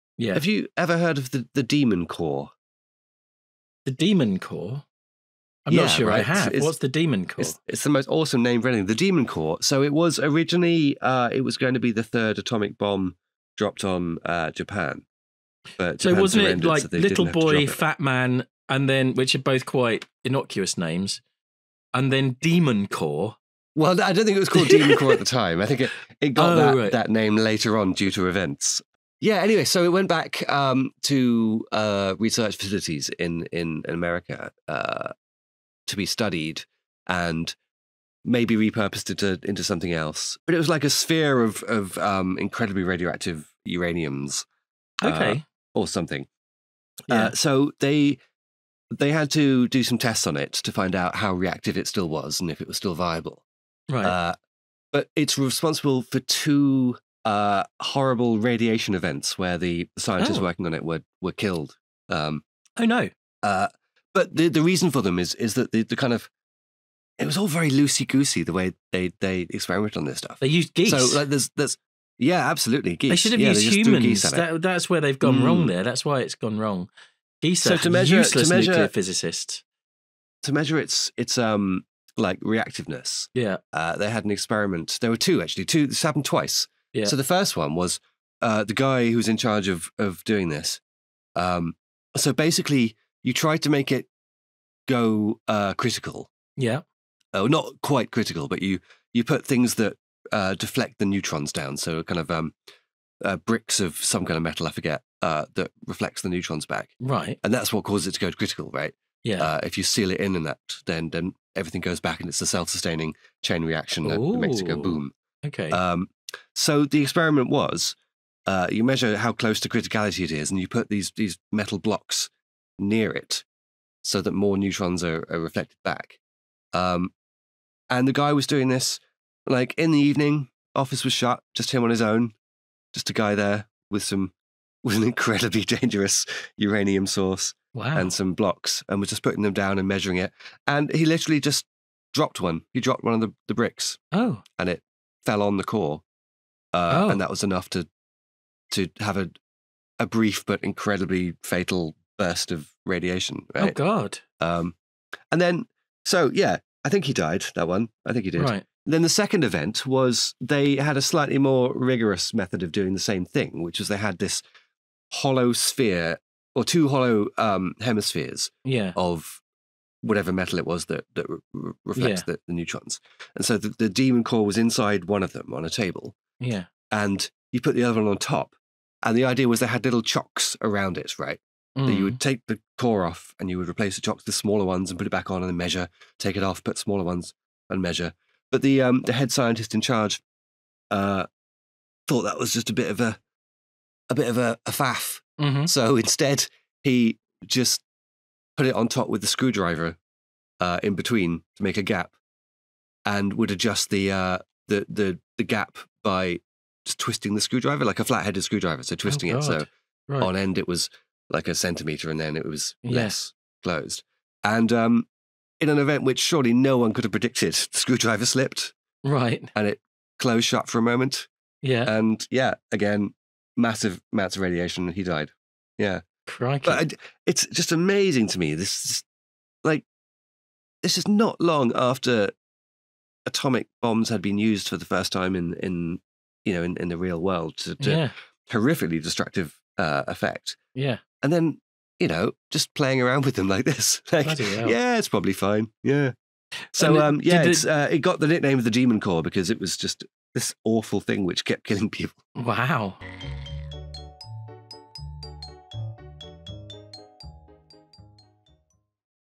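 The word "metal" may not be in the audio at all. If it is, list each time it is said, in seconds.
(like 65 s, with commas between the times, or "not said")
104 s, 121 s, 170 s.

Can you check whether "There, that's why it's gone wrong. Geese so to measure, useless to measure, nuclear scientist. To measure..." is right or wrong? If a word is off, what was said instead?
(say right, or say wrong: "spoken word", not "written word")
wrong: "physicist", not "scientist".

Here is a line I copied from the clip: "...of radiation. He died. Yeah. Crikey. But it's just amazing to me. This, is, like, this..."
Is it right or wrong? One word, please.
right.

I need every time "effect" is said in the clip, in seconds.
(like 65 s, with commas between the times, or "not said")
240 s.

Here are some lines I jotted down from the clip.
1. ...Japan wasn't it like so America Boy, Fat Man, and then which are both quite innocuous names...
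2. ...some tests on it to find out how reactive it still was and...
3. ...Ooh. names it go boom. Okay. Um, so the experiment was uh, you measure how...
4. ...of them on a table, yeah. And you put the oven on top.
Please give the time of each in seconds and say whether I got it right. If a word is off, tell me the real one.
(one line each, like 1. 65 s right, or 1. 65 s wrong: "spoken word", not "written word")
1. 16 s wrong: "Little", not "America"
2. 49 s right
3. 114 s wrong: "makes", not "names"
4. 175 s right.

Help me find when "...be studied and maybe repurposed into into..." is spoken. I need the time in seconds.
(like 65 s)
35 s.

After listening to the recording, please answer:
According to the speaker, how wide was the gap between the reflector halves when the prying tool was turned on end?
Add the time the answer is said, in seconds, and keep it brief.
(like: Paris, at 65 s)
A centimeter, at 211 s.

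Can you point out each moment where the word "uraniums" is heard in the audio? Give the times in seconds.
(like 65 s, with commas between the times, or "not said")
43 s, 136 s.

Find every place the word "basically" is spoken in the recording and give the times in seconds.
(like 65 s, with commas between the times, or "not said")
92 s.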